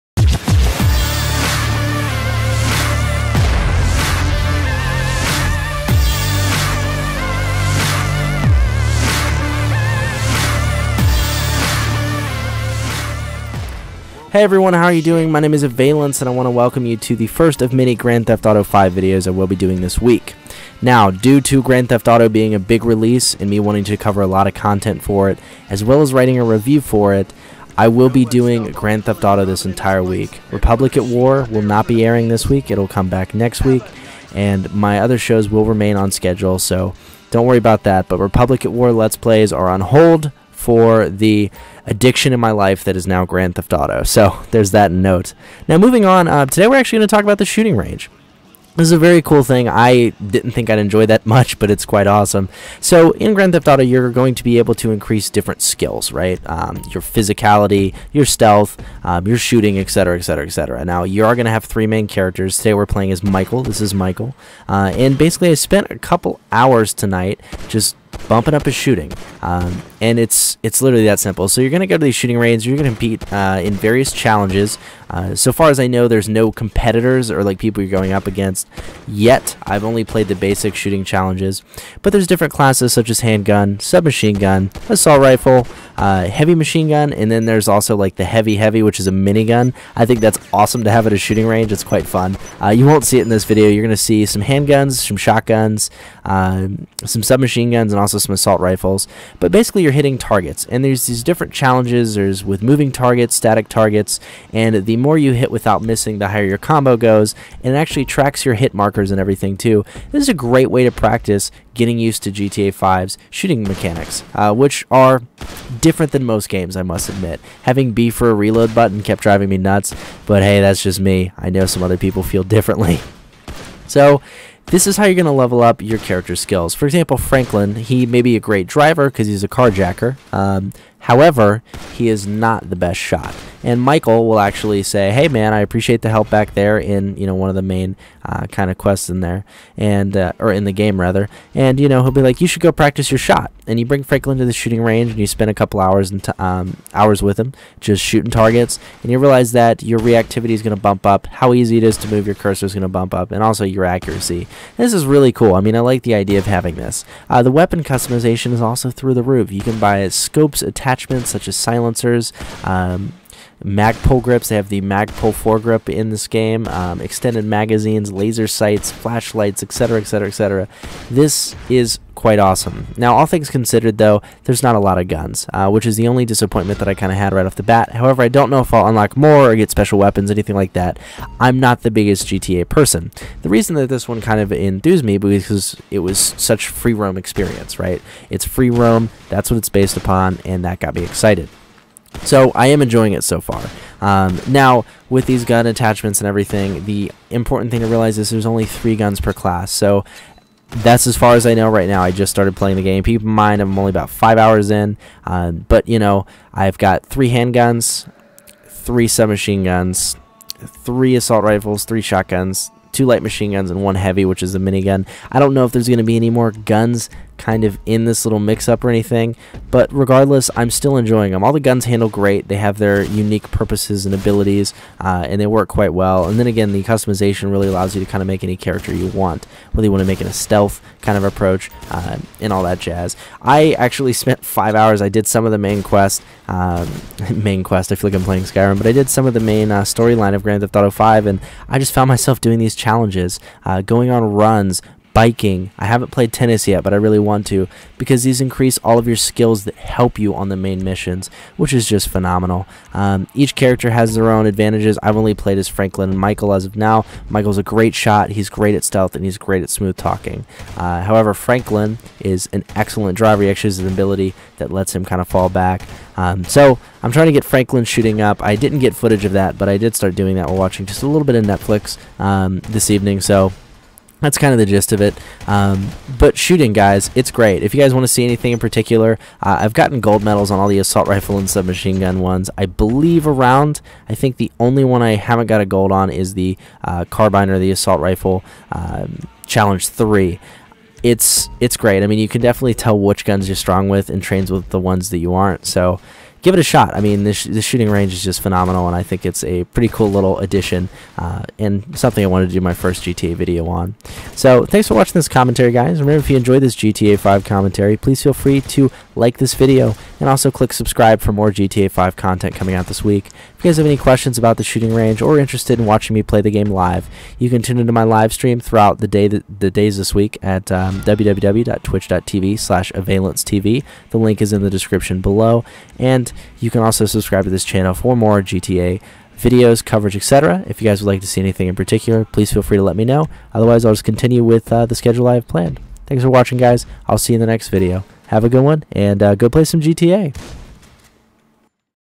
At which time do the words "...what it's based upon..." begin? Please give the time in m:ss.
3:09.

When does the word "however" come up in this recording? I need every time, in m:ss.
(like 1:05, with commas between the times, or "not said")
2:10, 2:57, 4:21.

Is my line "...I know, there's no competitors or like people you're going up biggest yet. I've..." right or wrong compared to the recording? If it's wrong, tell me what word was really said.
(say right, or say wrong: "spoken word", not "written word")
wrong: "against", not "biggest".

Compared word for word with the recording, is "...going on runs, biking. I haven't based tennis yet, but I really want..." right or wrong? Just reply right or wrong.
wrong.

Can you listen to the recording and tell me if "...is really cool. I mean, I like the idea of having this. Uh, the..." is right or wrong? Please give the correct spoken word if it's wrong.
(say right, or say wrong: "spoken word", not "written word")
right.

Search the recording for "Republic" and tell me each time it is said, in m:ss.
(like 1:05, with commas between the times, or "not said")
0:30, 0:38.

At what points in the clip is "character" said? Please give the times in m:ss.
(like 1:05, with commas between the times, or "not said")
1:02, 2:05, 3:48, 4:13.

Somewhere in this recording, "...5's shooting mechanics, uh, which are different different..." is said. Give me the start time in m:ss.
1:52.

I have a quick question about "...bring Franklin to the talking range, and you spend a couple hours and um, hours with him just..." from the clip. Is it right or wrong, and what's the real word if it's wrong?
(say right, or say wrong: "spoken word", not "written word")
wrong: "shooting", not "talking".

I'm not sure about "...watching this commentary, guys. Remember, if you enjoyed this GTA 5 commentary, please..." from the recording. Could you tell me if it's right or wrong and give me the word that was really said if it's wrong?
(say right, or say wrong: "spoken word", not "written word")
right.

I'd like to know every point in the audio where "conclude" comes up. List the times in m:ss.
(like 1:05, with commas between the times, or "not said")
not said.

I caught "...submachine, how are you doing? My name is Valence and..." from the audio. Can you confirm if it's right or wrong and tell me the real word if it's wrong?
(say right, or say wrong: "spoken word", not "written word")
wrong: "everyone", not "submachine".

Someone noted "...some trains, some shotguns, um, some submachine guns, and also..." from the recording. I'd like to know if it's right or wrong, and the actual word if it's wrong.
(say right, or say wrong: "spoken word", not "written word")
wrong: "handguns", not "trains".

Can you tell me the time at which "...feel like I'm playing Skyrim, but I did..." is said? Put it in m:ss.
3:57.